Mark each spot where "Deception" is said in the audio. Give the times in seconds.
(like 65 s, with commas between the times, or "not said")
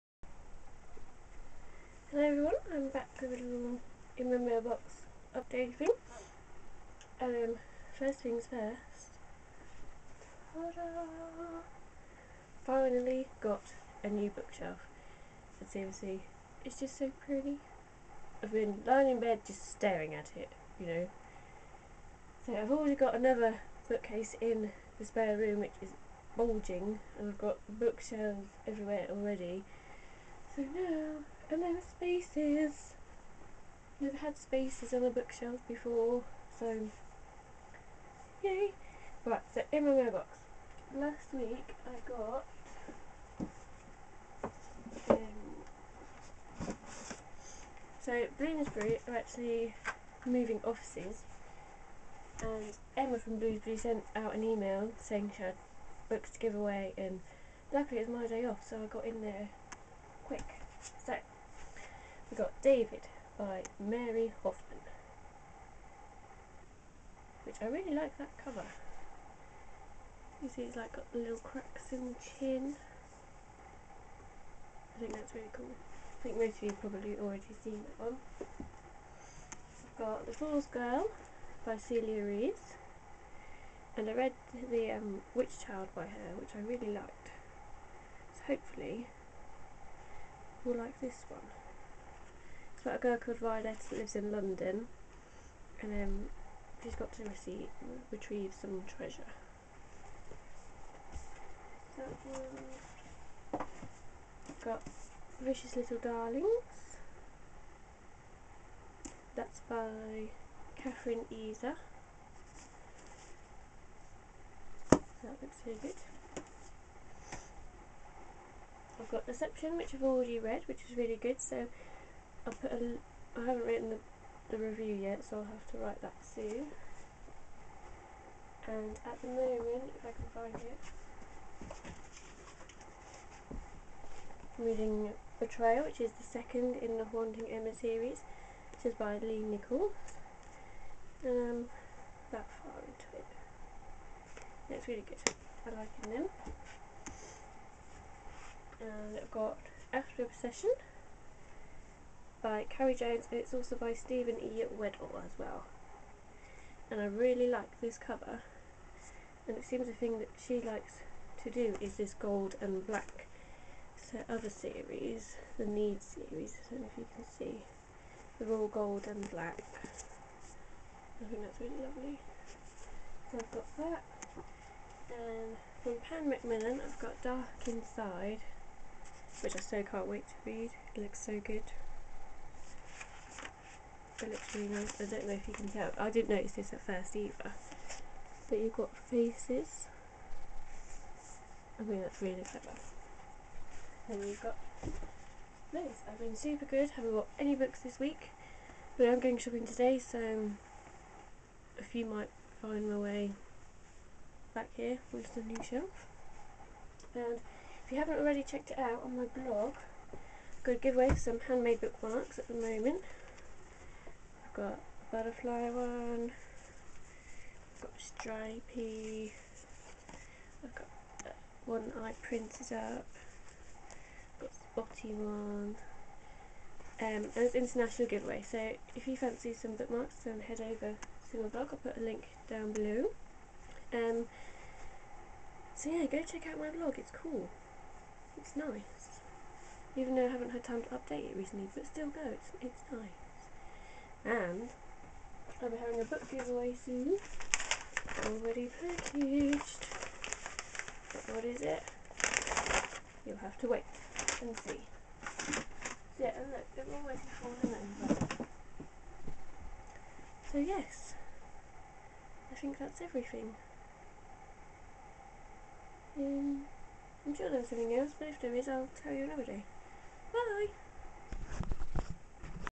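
119 s.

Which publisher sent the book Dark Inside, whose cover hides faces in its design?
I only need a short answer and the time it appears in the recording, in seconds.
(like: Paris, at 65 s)
Pan Macmillan, at 176 s.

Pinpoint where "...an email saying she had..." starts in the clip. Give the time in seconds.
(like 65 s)
54 s.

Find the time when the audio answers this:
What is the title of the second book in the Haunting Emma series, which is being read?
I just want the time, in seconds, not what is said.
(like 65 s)
135 s.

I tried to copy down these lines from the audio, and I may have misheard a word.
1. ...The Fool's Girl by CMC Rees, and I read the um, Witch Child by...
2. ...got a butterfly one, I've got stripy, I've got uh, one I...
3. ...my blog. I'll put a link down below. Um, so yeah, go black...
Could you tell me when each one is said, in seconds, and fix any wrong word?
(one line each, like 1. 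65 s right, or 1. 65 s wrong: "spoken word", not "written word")
1. 80 s wrong: "Celia", not "CMC"
2. 214 s right
3. 231 s wrong: "check", not "black".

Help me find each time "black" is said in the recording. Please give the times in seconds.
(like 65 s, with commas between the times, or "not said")
162 s, 169 s.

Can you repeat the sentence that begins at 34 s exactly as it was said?
Never had spaces on the bookshelf before, so yay.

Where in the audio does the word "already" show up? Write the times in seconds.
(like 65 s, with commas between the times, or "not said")
22 s, 29 s, 77 s, 120 s, 208 s, 248 s.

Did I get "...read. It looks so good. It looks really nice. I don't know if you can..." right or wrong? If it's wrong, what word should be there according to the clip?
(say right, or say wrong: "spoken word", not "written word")
right.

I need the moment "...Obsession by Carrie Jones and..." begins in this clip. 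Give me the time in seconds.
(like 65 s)
150 s.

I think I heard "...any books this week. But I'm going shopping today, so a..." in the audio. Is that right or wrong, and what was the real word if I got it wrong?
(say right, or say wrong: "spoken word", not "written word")
right.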